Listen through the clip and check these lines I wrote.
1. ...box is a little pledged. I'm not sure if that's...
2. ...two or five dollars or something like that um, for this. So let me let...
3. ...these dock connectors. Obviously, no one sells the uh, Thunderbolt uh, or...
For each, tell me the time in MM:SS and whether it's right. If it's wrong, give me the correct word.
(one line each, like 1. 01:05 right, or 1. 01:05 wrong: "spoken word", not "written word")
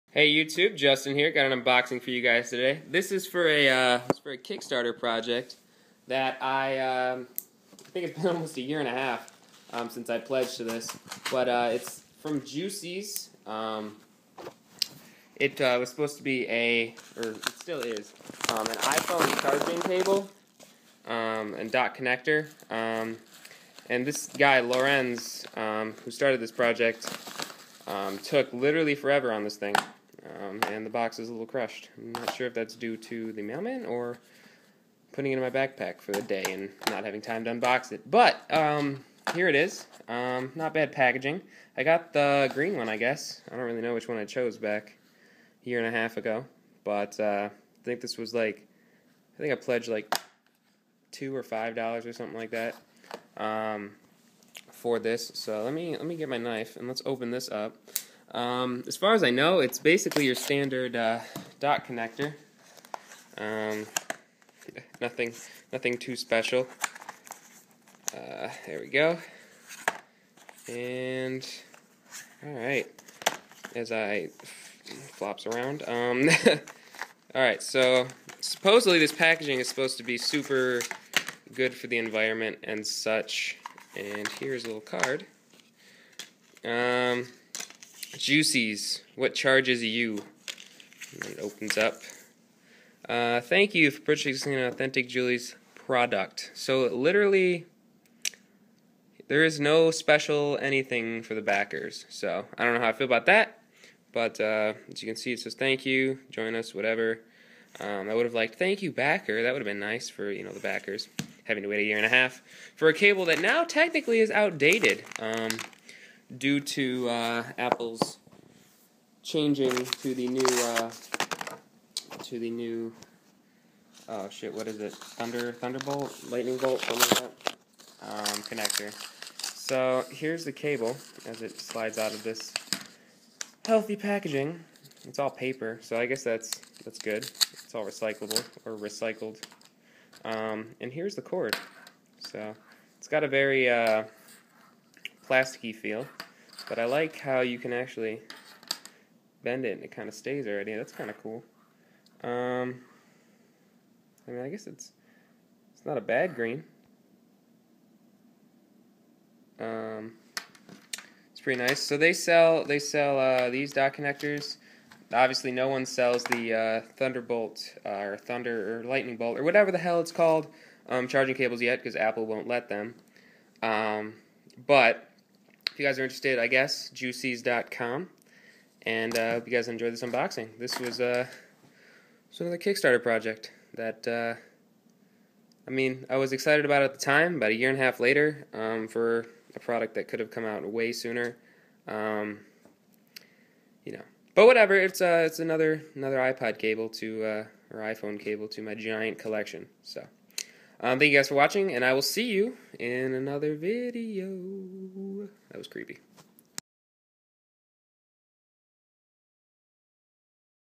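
1. 00:30 wrong: "crushed", not "pledged"
2. 00:51 right
3. 02:43 right.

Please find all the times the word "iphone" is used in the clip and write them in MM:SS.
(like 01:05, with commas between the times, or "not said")
00:18, 03:17.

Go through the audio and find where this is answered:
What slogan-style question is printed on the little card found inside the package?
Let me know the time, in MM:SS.
01:29.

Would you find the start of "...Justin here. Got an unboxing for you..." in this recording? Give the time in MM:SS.
00:00.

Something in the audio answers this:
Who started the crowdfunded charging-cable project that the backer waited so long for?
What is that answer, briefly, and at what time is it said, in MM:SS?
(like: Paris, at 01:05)
Lorenz, at 00:24.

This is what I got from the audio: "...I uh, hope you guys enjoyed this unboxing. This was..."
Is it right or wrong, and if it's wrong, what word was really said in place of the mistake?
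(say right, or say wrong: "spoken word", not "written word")
right.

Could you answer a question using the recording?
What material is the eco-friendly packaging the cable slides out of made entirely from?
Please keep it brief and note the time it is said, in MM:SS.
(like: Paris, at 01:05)
Paper, at 02:15.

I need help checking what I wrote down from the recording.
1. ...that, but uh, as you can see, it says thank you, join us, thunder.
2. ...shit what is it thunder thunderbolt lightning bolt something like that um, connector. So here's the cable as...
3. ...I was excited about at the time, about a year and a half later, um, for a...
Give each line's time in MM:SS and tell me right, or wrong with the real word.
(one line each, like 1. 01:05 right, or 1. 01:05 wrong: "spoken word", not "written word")
1. 01:43 wrong: "whatever", not "thunder"
2. 02:04 right
3. 03:06 right.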